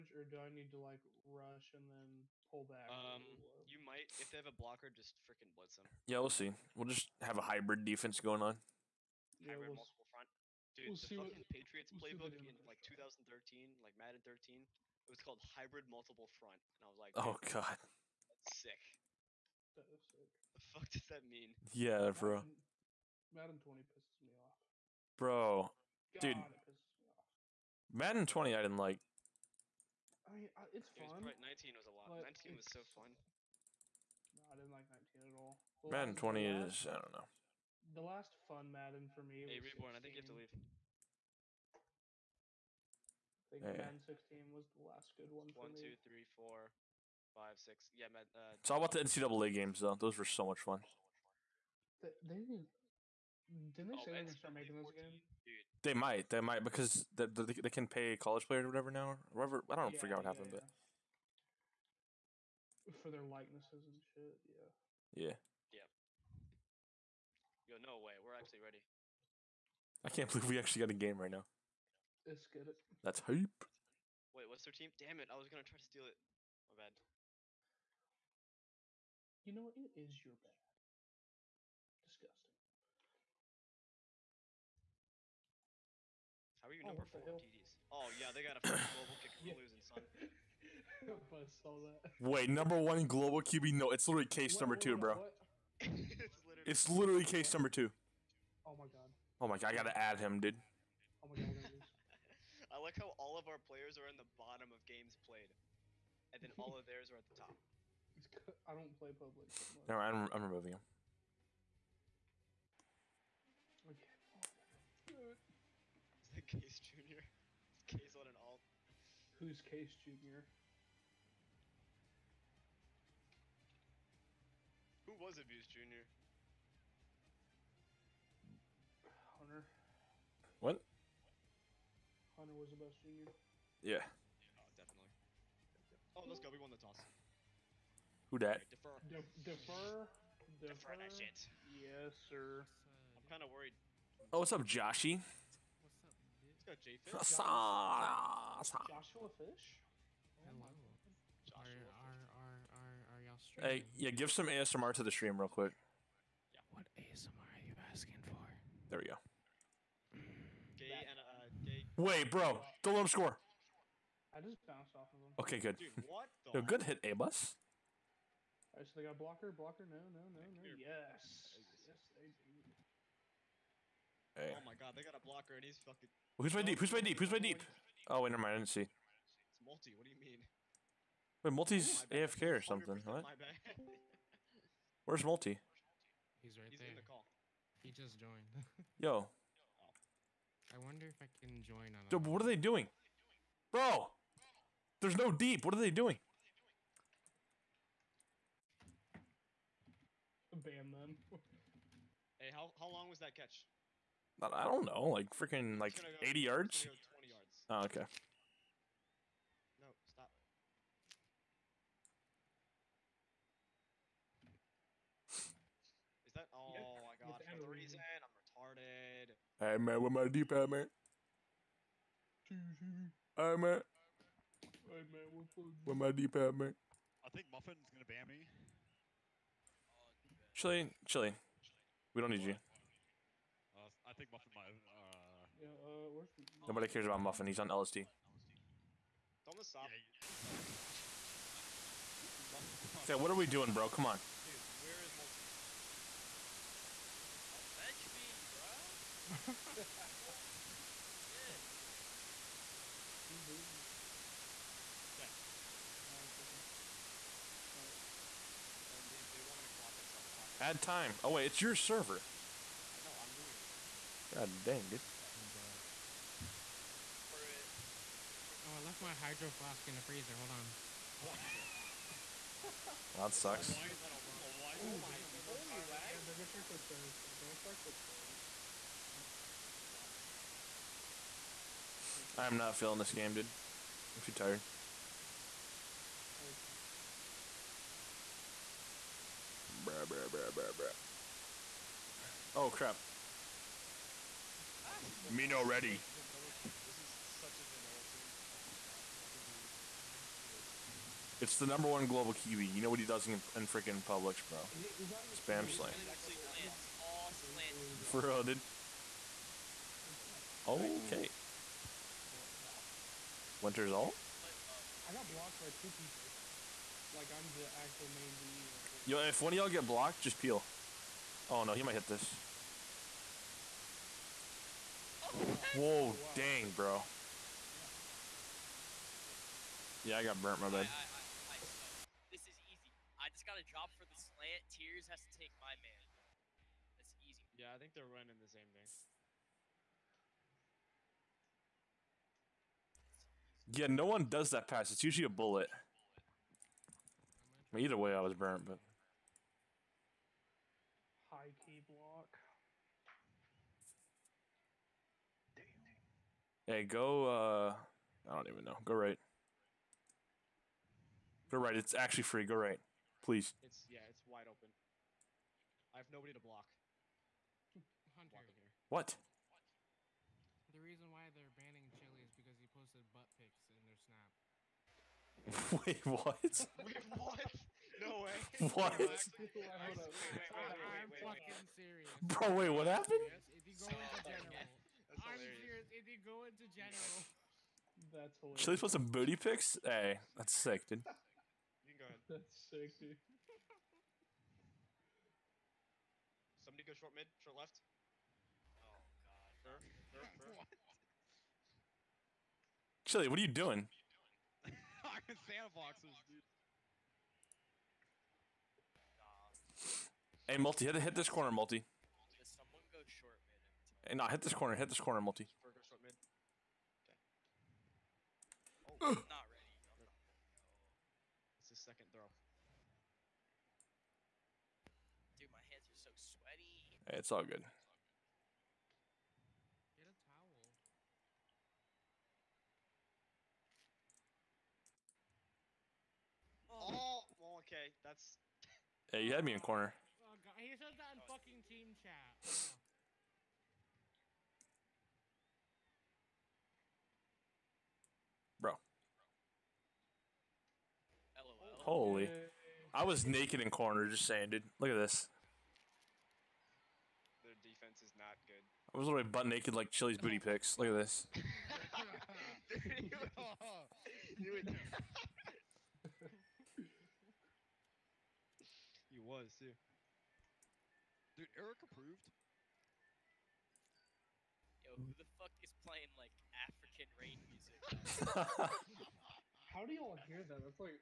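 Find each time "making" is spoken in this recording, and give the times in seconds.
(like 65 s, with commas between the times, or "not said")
54 s.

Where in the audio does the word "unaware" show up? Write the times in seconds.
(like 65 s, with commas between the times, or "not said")
not said.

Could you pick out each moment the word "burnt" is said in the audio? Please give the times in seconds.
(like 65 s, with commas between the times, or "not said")
330 s, 348 s.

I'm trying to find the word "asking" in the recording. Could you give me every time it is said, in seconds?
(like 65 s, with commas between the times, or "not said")
157 s.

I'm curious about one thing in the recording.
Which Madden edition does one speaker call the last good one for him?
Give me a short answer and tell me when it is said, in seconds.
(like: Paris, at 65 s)
Madden 16, at 43 s.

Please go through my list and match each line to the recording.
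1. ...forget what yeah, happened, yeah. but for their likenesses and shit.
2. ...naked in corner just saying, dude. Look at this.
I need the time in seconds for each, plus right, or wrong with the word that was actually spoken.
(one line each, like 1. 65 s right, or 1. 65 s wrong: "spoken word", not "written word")
1. 60 s right
2. 453 s right.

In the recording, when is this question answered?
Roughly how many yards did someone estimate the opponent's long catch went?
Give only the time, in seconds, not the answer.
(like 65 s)
206 s.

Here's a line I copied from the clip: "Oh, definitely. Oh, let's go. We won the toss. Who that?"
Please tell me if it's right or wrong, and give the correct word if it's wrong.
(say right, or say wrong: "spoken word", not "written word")
right.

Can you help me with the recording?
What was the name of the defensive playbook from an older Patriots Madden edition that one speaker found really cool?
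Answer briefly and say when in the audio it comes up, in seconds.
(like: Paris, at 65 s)
hybrid multiple front, at 15 s.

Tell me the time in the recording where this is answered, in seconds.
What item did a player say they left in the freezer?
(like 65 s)
269 s.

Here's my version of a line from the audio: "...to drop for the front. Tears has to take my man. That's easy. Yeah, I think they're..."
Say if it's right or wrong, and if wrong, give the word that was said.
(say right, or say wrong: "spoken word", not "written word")
wrong: "slant", not "front".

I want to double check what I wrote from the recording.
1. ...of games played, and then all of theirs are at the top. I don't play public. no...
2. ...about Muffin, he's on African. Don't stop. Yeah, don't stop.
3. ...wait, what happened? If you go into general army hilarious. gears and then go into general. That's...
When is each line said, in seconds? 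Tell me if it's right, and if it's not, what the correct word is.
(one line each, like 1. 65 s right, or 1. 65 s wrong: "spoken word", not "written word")
1. 104 s right
2. 237 s wrong: "LSD", not "African"
3. 382 s right.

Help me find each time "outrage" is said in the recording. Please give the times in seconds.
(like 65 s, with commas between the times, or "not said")
not said.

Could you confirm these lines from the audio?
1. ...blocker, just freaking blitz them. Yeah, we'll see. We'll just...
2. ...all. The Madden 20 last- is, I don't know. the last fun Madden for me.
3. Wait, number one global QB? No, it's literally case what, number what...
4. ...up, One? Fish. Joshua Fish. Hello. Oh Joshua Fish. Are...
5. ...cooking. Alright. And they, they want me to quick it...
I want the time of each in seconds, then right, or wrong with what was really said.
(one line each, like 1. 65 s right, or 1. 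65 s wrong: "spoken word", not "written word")
1. 4 s right
2. 35 s right
3. 92 s right
4. 144 s wrong: "Joshy", not "One"
5. 256 s wrong: "clock", not "quick".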